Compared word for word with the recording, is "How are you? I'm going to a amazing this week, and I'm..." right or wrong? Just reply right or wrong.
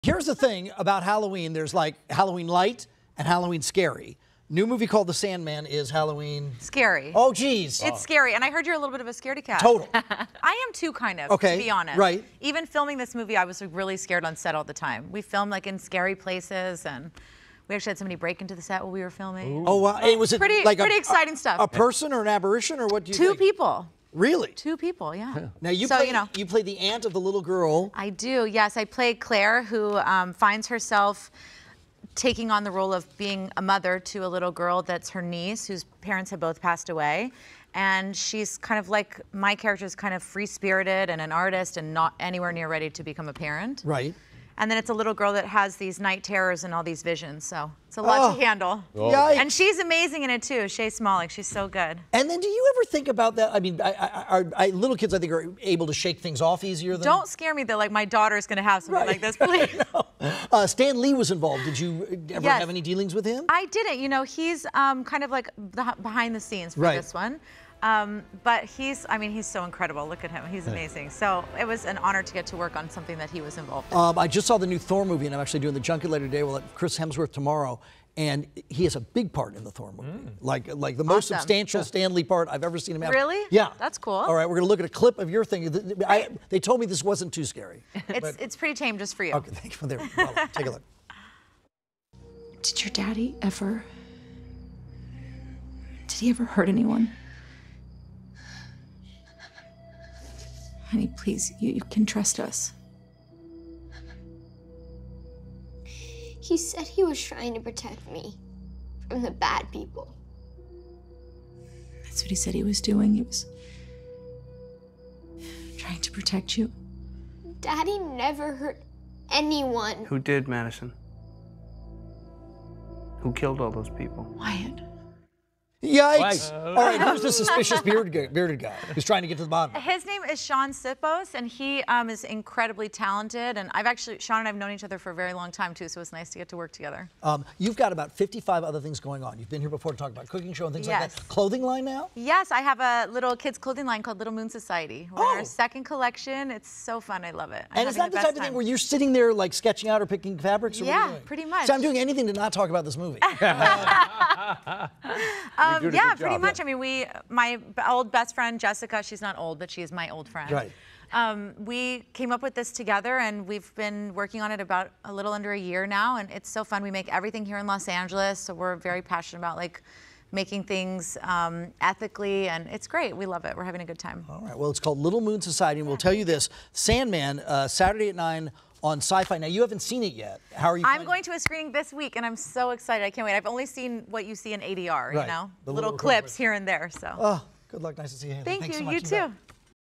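wrong.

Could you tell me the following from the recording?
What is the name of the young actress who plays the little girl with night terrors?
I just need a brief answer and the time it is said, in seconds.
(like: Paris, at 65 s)
Shae Smolik, at 50 s.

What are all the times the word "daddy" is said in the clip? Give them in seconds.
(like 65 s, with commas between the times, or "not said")
92 s, 117 s.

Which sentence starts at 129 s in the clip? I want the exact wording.
His name is Sean Sipos, and he um, is incredibly talented.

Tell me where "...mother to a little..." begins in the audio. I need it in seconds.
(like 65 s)
33 s.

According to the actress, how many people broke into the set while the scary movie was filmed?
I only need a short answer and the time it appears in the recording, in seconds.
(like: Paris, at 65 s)
2, at 24 s.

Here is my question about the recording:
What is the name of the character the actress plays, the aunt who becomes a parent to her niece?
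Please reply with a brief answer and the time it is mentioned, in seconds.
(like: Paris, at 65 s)
Claire, at 29 s.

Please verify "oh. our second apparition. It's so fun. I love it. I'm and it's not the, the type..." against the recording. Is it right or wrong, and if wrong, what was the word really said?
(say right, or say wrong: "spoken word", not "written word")
wrong: "collection", not "apparition".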